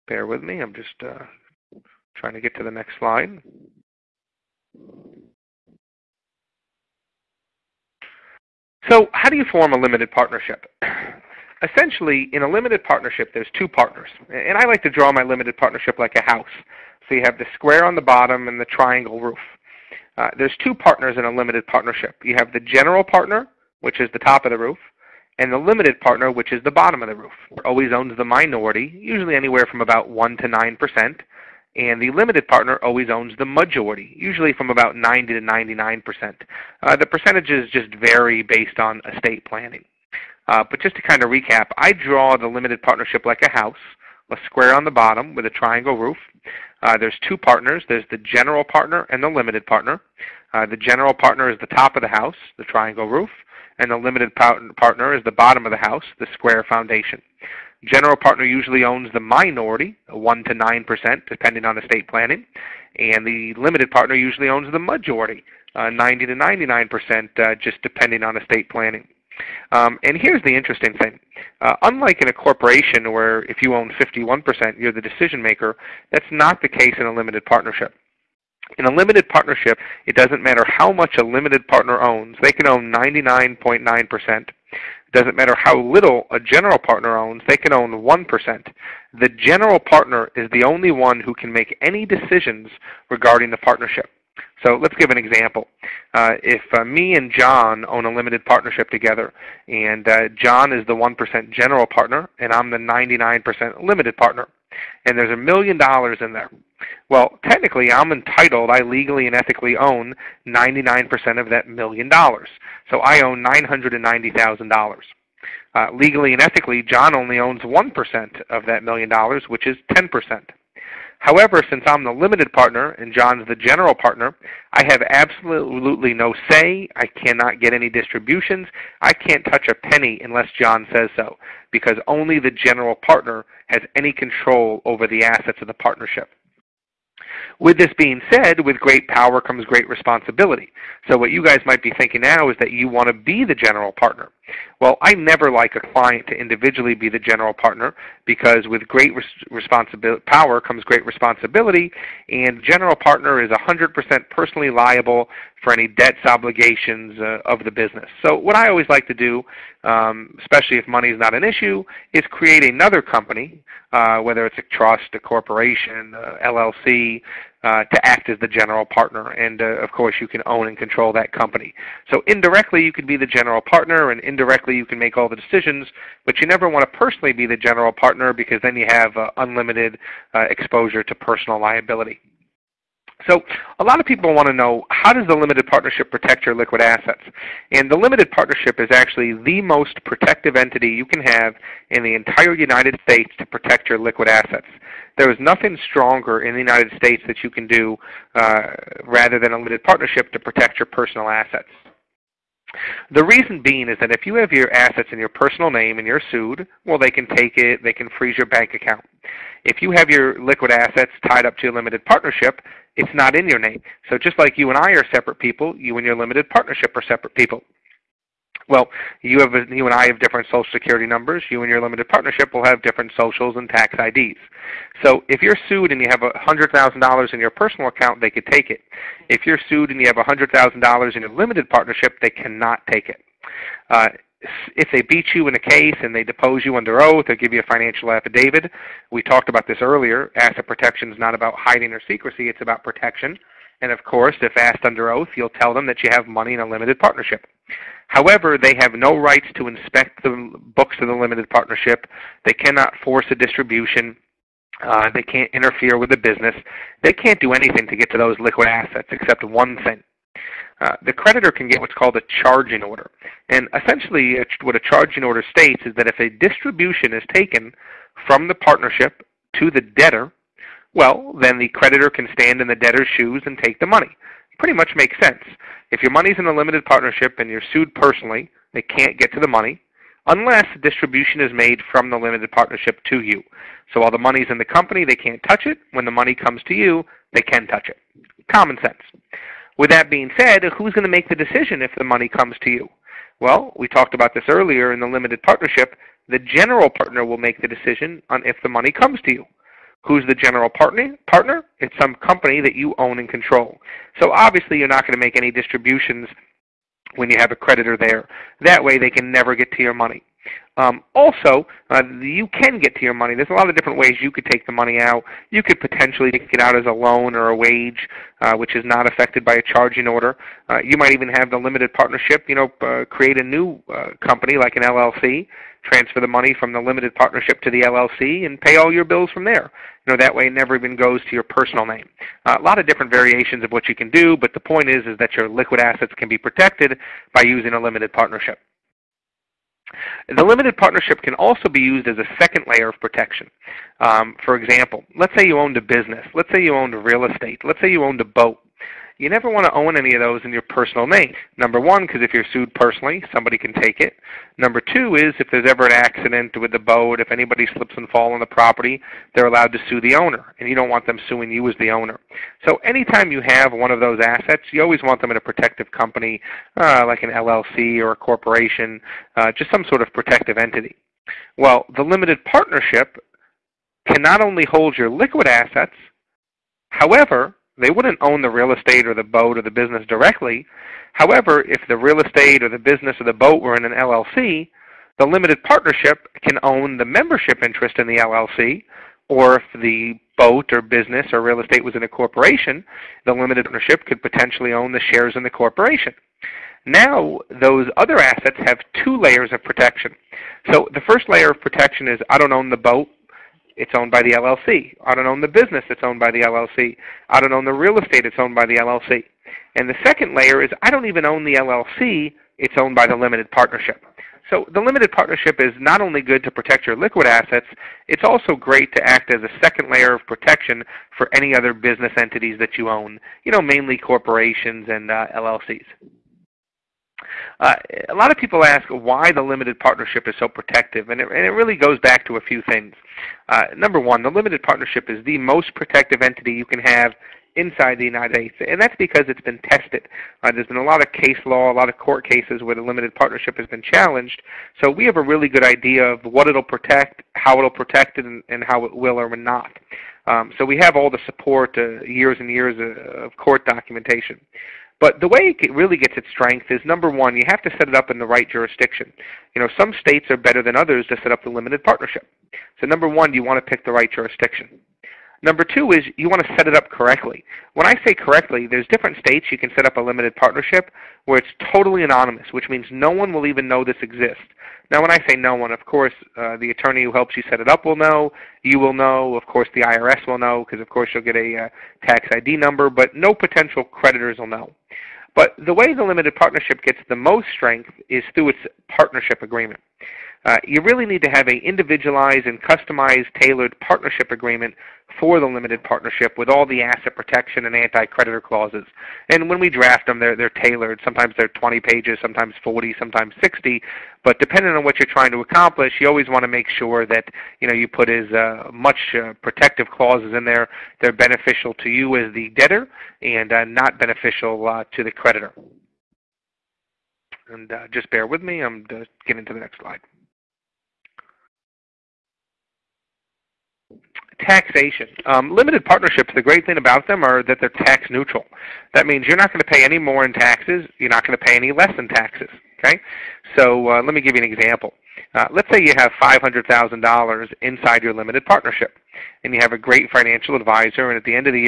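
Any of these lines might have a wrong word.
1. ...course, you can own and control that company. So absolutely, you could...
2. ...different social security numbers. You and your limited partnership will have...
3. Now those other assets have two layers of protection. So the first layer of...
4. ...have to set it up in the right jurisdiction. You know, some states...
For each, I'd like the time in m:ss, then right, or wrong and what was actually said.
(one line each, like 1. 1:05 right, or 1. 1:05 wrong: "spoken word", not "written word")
1. 2:49 wrong: "indirectly", not "absolutely"
2. 3:40 right
3. 6:36 right
4. 7:37 right.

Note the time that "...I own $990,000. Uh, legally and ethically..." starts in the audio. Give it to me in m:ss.
1:52.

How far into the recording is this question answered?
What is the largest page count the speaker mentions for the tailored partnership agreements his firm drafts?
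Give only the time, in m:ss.
8:23.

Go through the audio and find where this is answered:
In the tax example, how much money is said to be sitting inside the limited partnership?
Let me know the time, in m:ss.
8:56.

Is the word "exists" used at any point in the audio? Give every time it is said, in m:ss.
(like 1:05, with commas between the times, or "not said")
7:54.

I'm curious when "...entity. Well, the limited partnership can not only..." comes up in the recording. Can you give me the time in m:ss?
6:10.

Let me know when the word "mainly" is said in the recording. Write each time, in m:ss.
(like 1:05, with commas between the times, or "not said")
7:03.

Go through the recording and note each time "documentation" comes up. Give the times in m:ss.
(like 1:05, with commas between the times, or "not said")
7:33.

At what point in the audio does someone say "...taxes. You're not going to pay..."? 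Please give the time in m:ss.
8:50.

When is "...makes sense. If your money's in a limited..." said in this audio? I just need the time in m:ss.
4:34.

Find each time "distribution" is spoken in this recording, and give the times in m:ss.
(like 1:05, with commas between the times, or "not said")
2:07, 4:13, 4:26, 4:40, 5:05.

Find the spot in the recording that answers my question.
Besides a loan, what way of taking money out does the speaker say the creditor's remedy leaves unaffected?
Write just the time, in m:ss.
5:17.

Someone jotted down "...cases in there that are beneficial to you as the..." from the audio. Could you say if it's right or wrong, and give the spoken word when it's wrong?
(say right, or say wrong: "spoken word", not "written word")
wrong: "clauses", not "cases".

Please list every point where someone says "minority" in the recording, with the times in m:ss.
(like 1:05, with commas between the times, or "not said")
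0:28, 0:59.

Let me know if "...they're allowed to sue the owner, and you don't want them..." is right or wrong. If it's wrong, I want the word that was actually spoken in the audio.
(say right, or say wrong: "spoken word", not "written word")
right.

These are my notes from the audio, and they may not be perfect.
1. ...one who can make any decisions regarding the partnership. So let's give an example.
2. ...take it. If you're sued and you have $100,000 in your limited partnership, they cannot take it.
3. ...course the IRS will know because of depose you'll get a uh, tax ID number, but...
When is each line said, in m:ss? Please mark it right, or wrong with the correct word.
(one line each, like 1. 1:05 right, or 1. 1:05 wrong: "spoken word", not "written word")
1. 1:30 right
2. 3:48 right
3. 7:59 wrong: "course", not "depose".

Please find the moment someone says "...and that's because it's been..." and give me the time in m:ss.
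7:18.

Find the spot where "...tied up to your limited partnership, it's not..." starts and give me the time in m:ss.
3:31.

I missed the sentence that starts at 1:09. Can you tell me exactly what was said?
Um, and here's the interesting thing.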